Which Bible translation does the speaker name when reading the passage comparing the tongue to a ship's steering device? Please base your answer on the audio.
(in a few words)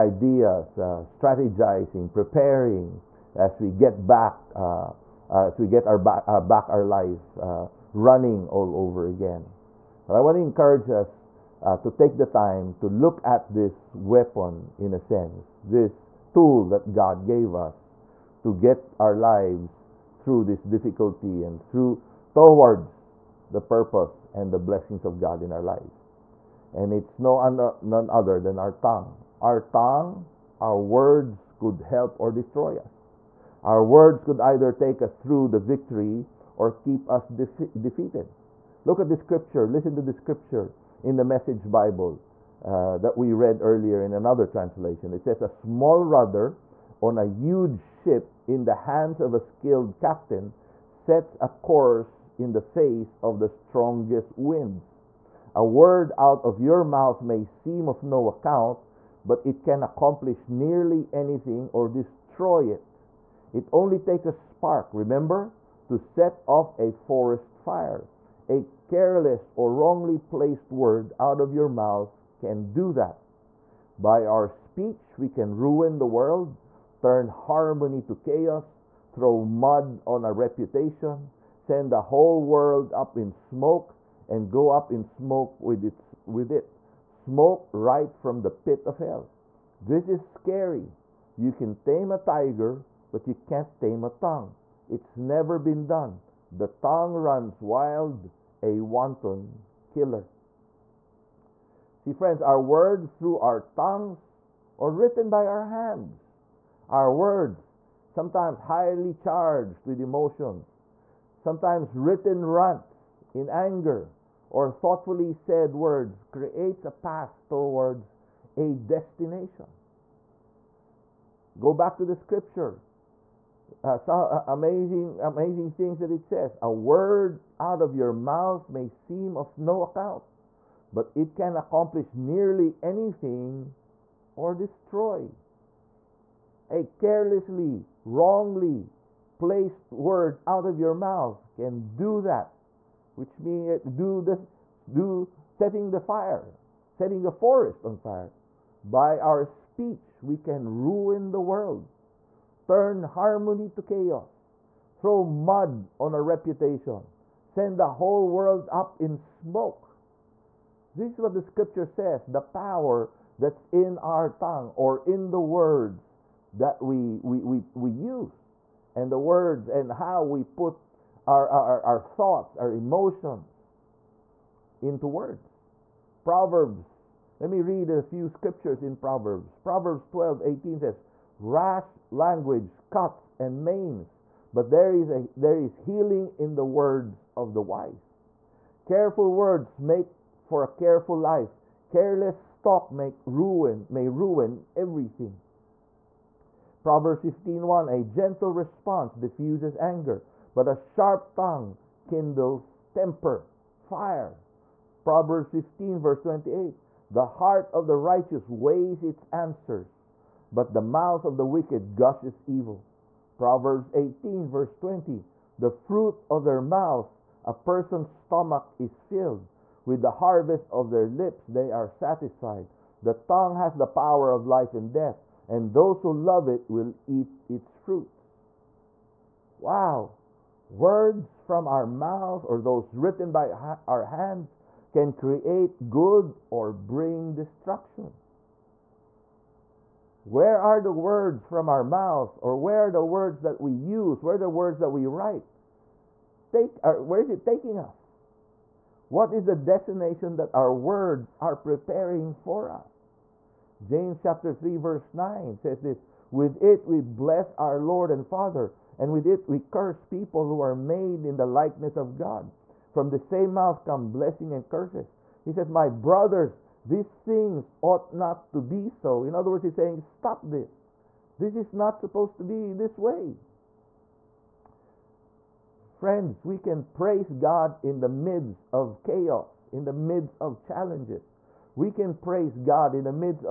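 Message Bible.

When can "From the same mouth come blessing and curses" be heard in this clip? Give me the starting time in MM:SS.
04:22.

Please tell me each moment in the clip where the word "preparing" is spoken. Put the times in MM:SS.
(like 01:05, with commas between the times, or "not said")
00:02, 04:11.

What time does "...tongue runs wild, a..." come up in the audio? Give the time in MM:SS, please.
01:36.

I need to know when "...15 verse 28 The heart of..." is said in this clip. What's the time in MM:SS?
03:25.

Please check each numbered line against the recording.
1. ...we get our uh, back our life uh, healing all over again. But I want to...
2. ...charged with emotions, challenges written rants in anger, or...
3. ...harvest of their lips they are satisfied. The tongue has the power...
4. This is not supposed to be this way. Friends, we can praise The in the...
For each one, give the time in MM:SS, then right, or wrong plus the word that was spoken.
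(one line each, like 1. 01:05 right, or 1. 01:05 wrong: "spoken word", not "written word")
1. 00:05 wrong: "running", not "healing"
2. 01:49 wrong: "sometimes", not "challenges"
3. 03:40 right
4. 04:31 wrong: "God", not "The".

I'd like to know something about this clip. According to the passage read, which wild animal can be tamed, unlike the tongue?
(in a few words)
tiger.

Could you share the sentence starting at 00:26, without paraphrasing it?
And it's no uh, none other than our tongue.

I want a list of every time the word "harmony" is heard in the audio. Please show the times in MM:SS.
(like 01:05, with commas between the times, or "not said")
01:17, 02:33.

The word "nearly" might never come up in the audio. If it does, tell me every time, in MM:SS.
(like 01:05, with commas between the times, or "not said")
01:00, 02:12.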